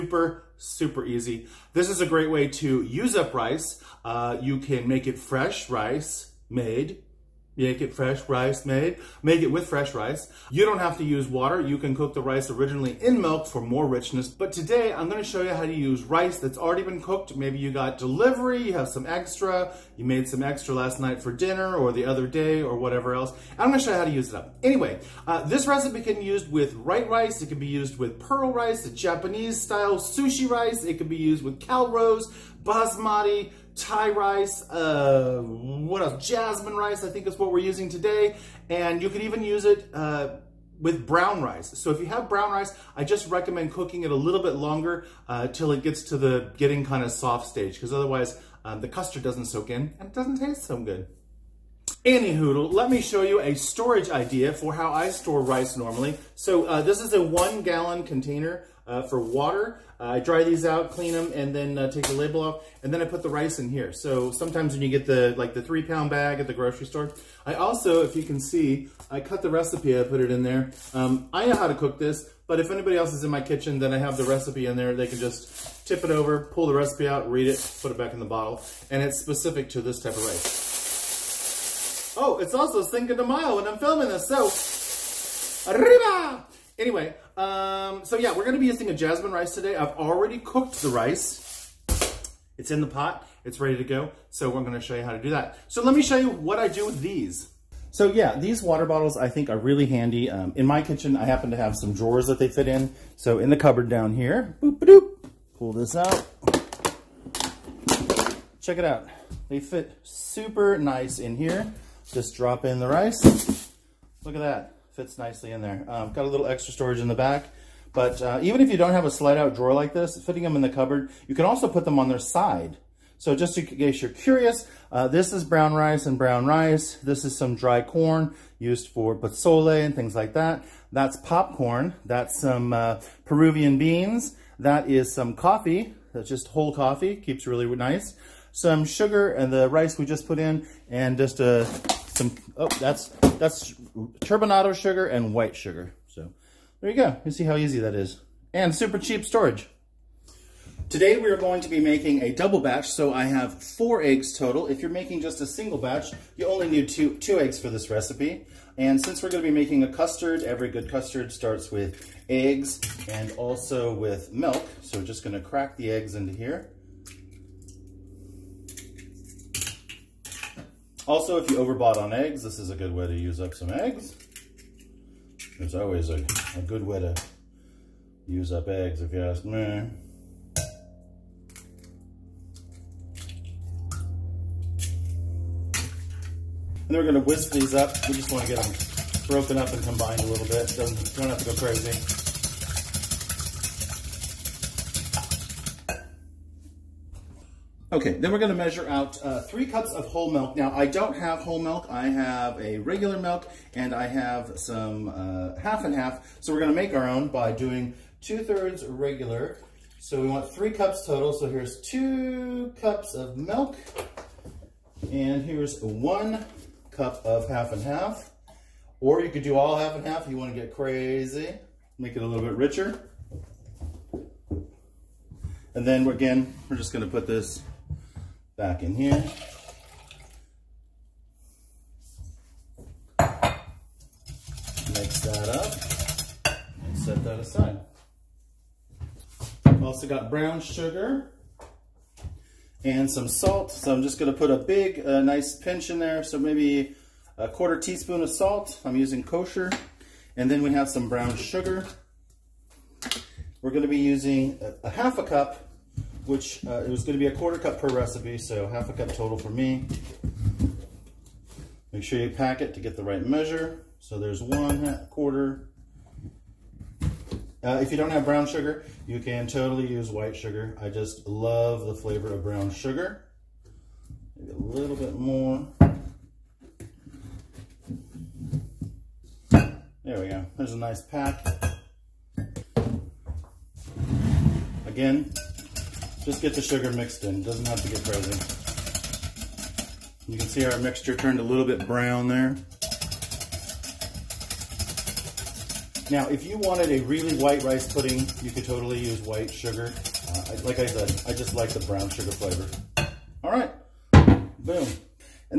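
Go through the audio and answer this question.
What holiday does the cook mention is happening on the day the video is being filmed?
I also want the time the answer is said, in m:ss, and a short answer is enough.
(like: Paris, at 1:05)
Cinco de Mayo, at 1:22.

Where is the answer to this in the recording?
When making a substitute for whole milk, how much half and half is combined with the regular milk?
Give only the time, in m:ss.
3:35.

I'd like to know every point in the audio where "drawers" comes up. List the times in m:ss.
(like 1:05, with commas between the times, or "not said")
1:41, 1:59.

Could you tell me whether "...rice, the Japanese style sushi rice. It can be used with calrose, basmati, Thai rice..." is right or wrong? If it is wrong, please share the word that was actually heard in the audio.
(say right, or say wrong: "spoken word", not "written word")
right.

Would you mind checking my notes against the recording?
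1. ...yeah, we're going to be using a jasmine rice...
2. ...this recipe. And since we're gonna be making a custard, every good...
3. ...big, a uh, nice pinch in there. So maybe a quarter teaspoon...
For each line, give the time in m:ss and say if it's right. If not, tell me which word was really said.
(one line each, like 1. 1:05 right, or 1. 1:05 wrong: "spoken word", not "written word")
1. 1:28 right
2. 2:37 right
3. 4:04 right.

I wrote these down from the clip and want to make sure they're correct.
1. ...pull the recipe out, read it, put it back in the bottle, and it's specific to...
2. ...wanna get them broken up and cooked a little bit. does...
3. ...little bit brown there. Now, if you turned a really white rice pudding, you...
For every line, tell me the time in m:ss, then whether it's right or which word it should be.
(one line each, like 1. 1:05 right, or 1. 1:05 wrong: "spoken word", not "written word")
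1. 1:16 right
2. 3:08 wrong: "combined", not "cooked"
3. 4:51 wrong: "wanted", not "turned".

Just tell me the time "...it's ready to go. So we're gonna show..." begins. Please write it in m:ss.
1:33.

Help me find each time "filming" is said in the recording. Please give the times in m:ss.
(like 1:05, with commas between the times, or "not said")
1:23.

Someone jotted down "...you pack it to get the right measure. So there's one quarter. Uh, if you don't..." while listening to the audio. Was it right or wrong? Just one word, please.
right.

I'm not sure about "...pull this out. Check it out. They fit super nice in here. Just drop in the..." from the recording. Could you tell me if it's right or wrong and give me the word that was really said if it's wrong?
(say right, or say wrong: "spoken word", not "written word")
right.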